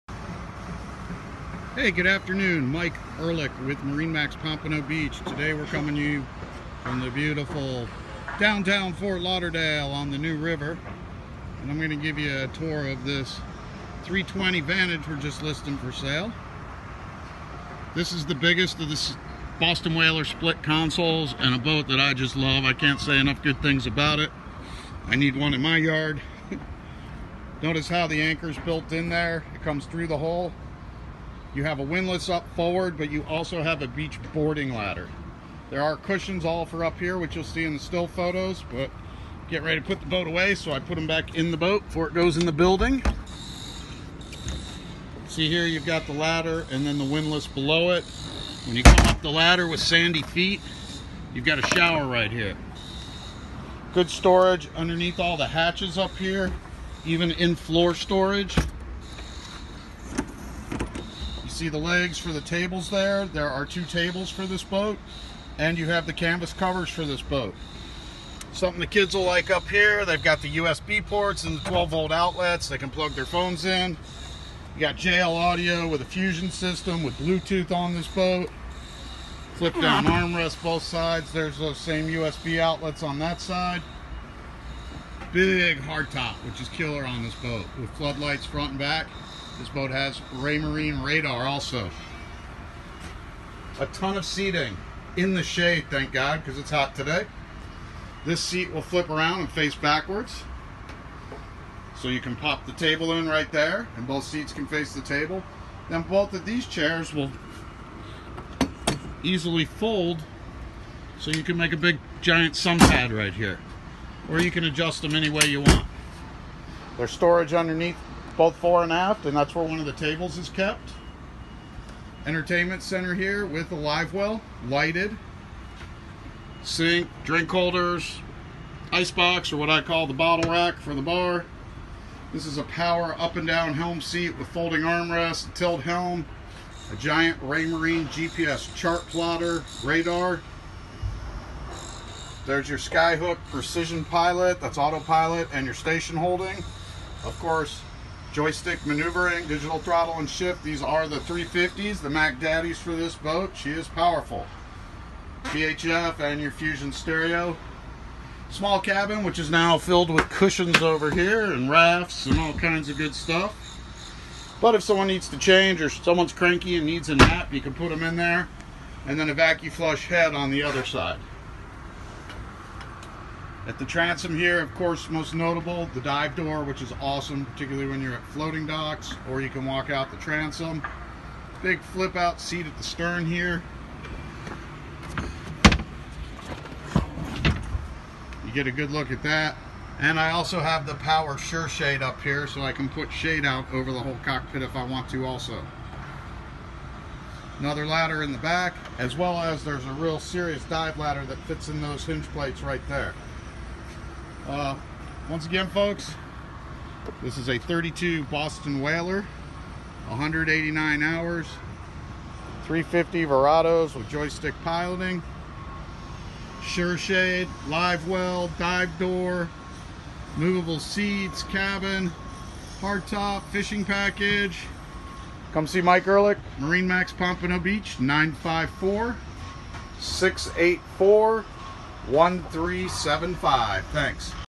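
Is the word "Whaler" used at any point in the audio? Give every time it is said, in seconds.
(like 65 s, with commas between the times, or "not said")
19 s, 208 s.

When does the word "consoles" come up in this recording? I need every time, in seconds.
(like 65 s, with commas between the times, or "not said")
20 s.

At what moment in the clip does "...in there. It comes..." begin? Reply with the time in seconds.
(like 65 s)
28 s.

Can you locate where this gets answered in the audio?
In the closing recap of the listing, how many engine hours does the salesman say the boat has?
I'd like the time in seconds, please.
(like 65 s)
210 s.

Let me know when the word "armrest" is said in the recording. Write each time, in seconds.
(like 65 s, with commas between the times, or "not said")
80 s, 134 s.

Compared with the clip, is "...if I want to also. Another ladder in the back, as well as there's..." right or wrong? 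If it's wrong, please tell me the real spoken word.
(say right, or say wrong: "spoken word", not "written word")
right.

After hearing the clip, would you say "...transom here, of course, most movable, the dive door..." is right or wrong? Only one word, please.
wrong.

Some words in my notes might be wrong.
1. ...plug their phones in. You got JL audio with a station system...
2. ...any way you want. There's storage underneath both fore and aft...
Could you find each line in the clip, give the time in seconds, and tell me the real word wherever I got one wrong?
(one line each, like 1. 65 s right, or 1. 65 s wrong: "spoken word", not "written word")
1. 72 s wrong: "fusion", not "station"
2. 115 s right.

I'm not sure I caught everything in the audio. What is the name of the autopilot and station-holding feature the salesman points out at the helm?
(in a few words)
Skyhook Precision Pilot.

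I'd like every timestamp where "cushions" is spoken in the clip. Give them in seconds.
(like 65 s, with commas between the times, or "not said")
35 s, 160 s.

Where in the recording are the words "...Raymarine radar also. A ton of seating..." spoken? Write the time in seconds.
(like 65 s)
90 s.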